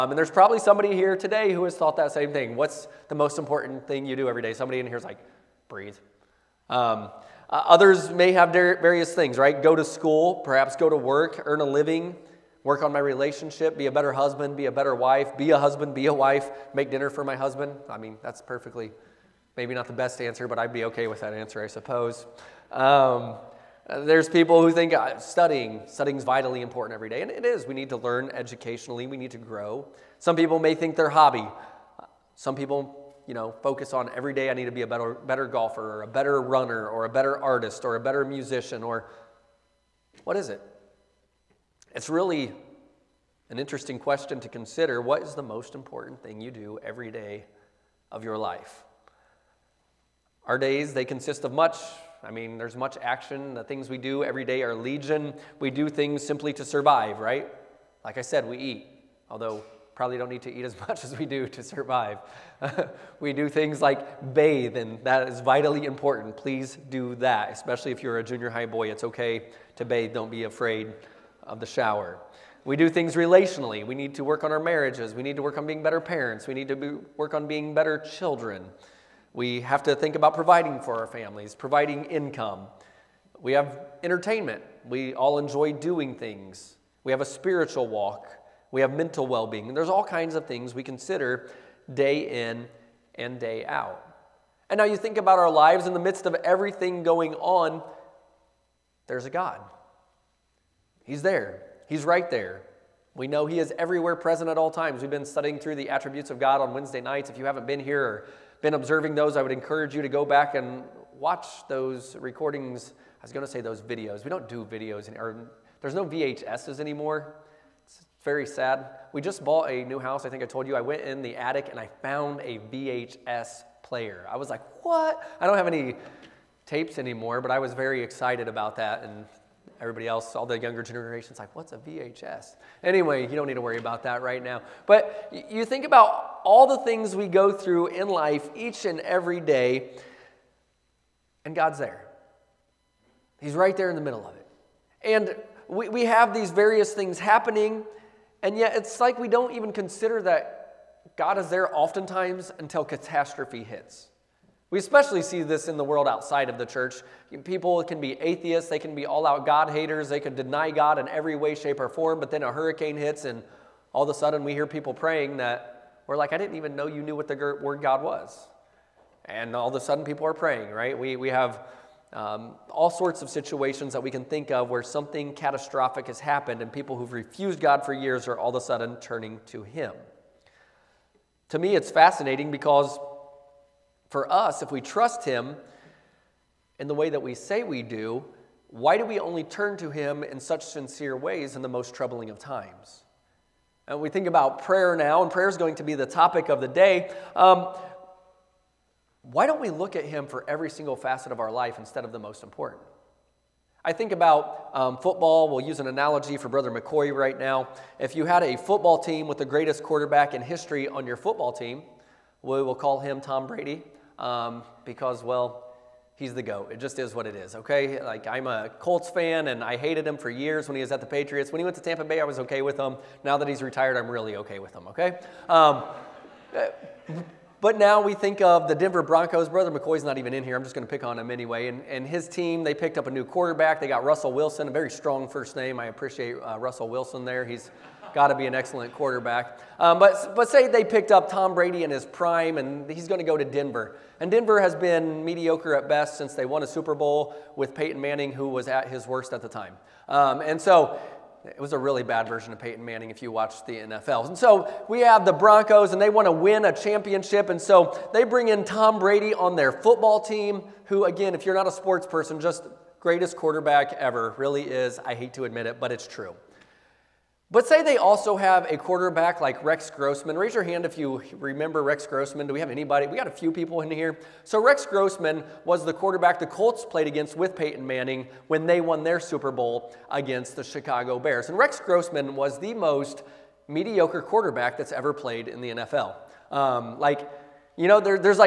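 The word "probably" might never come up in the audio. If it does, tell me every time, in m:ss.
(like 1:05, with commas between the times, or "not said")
0:00, 0:59.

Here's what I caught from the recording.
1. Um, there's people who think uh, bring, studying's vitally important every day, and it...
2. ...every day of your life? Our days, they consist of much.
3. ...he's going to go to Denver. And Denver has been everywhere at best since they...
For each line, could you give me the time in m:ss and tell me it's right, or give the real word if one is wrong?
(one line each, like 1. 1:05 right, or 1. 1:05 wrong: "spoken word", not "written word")
1. 0:22 wrong: "studying", not "bring"
2. 0:46 right
3. 4:02 wrong: "mediocre", not "everywhere".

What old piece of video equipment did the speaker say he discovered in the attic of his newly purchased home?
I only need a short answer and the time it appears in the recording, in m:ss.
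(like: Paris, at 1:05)
VHS player, at 2:02.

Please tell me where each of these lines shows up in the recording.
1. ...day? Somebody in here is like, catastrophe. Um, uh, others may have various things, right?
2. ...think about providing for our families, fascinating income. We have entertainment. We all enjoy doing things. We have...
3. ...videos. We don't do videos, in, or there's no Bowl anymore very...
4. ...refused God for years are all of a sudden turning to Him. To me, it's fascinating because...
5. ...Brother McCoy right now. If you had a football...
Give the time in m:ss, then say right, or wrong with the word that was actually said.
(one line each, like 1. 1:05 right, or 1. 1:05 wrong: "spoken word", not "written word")
1. 0:04 wrong: "breathe", not "catastrophe"
2. 1:19 wrong: "providing", not "fascinating"
3. 1:53 wrong: "VHSs", not "Bowl"
4. 2:57 right
5. 3:26 right.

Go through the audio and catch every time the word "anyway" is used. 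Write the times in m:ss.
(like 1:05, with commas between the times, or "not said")
2:12, 3:51.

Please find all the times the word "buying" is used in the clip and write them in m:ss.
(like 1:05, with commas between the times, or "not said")
not said.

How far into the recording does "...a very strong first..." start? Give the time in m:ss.
3:54.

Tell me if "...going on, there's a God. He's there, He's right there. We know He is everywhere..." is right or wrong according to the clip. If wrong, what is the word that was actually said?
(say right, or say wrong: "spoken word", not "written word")
right.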